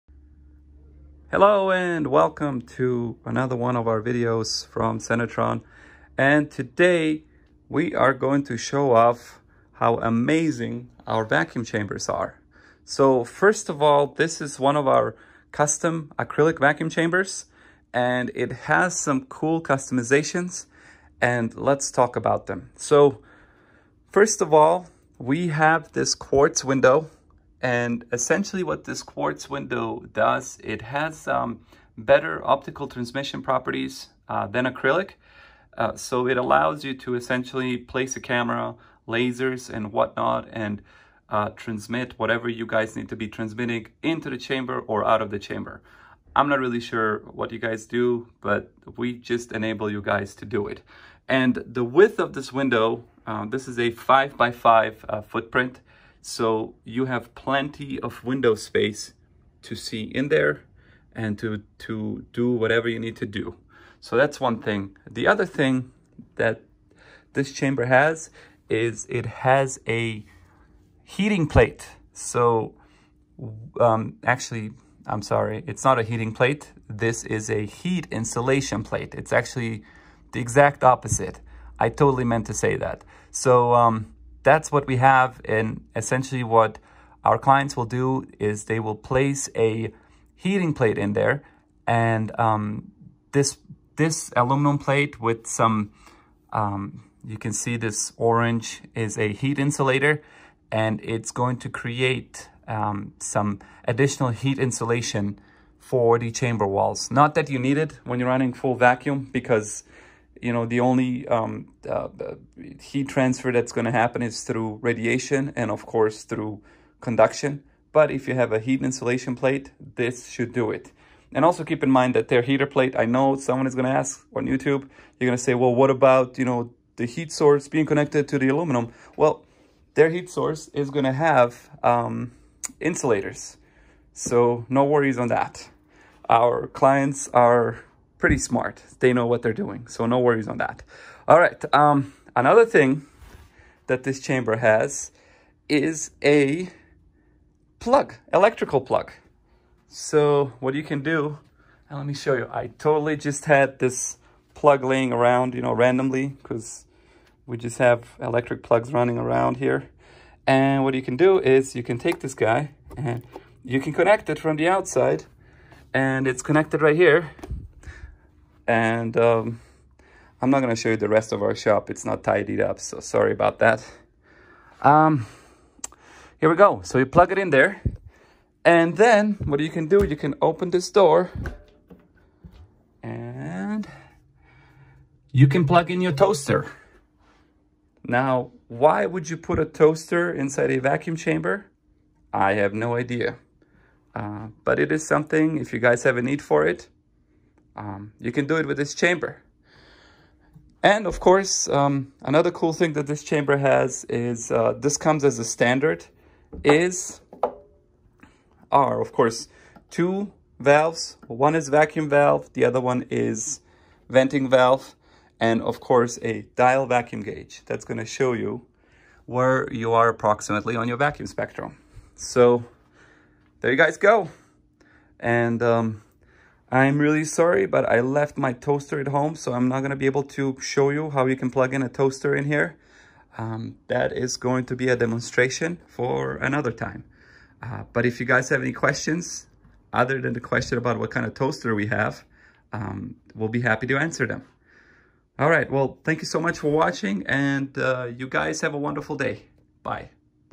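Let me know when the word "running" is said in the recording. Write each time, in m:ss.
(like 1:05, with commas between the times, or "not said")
1:48, 2:38.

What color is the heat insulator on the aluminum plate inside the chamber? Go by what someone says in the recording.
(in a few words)
Orange.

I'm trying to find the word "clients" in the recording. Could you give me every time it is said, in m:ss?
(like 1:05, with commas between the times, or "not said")
1:27, 2:16.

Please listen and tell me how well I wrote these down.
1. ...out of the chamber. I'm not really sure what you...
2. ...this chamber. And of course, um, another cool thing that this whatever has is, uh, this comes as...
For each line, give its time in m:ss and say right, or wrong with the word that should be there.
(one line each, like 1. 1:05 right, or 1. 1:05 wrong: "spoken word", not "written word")
1. 0:45 right
2. 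3:18 wrong: "chamber", not "whatever".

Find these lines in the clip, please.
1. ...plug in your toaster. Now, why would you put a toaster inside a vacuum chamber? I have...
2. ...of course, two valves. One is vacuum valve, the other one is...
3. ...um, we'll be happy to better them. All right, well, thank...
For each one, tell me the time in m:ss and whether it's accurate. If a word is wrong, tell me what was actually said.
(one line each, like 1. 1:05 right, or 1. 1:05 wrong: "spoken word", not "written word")
1. 3:05 right
2. 3:28 right
3. 4:02 wrong: "answer", not "better".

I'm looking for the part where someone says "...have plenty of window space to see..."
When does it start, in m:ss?
0:57.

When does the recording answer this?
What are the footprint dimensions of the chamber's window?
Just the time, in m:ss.
0:53.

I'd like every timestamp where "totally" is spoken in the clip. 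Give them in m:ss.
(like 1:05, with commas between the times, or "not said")
1:21, 2:32.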